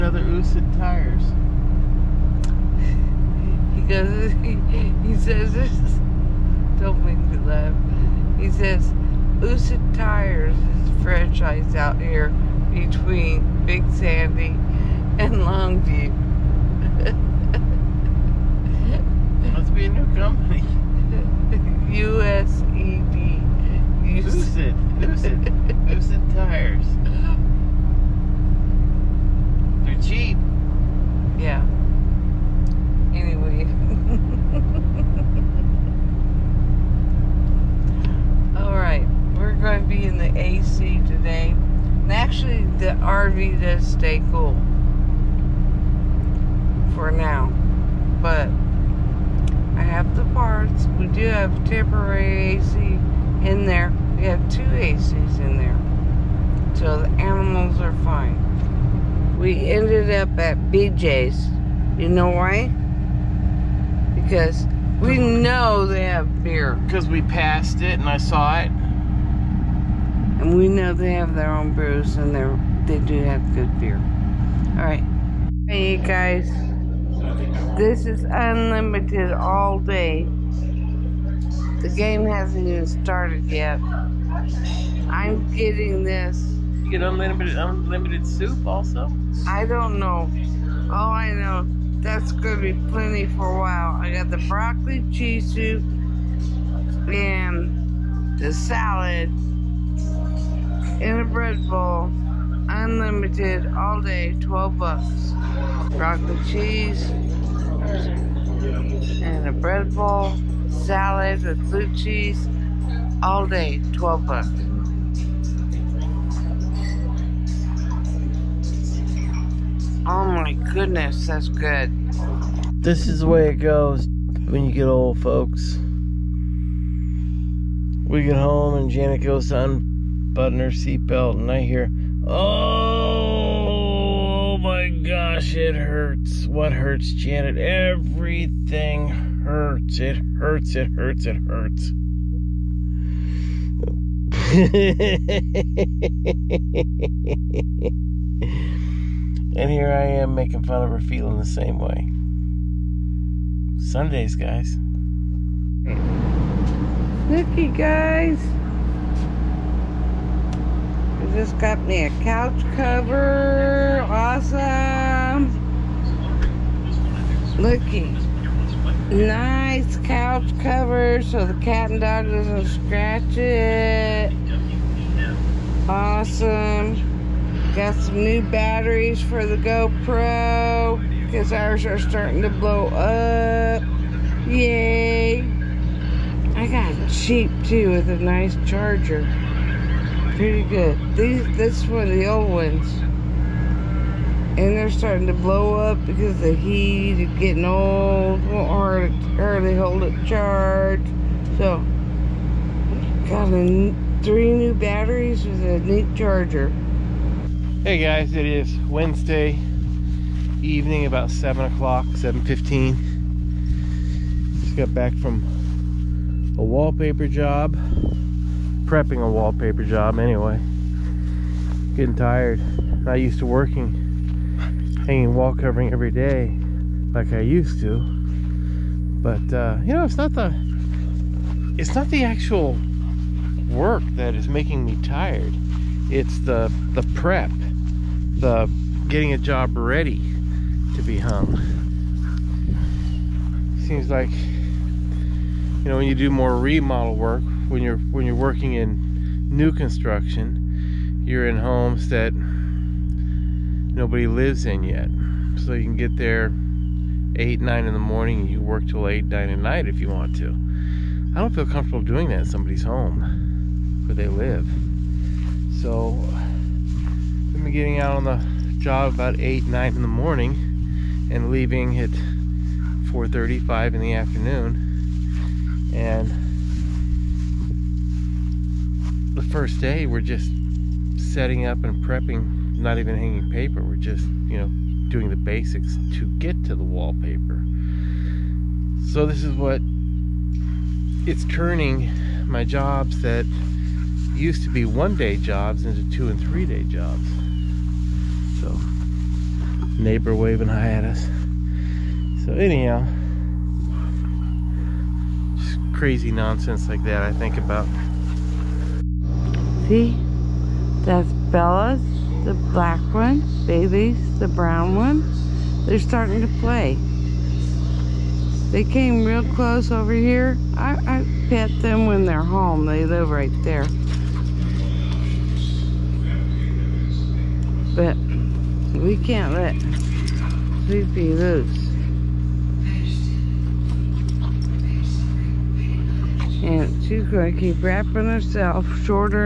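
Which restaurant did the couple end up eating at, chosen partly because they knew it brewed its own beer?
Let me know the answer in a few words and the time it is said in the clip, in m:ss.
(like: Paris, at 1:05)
BJ's, at 1:00.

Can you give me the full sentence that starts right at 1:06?
Because we passed it and I saw it.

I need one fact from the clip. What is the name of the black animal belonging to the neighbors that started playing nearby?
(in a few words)
Bella.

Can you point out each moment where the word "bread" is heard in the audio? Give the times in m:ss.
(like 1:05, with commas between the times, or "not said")
1:41, 1:49.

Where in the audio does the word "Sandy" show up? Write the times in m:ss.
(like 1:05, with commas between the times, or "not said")
0:13.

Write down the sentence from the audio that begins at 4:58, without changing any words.
So neighbor waving hi at us.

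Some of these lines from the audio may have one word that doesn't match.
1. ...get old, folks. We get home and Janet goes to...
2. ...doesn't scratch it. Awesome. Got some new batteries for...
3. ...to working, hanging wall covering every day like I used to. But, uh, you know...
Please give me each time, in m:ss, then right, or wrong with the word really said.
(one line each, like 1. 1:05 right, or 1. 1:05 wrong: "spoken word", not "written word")
1. 2:04 right
2. 2:52 right
3. 3:43 right.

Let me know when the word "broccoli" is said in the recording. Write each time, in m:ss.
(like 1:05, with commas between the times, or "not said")
1:34, 1:45.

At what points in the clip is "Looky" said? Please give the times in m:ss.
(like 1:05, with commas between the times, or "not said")
2:37, 2:47.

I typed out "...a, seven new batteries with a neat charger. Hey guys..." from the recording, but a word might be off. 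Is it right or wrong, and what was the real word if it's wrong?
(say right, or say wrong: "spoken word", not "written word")
wrong: "three", not "seven".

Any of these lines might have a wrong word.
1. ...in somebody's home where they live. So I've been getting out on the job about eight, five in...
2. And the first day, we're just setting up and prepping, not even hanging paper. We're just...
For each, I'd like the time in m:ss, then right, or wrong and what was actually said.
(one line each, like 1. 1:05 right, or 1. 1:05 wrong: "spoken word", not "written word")
1. 4:22 wrong: "nine", not "five"
2. 4:35 right.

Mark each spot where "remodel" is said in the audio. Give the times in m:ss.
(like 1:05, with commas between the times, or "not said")
4:06.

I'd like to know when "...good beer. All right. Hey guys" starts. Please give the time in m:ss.
1:13.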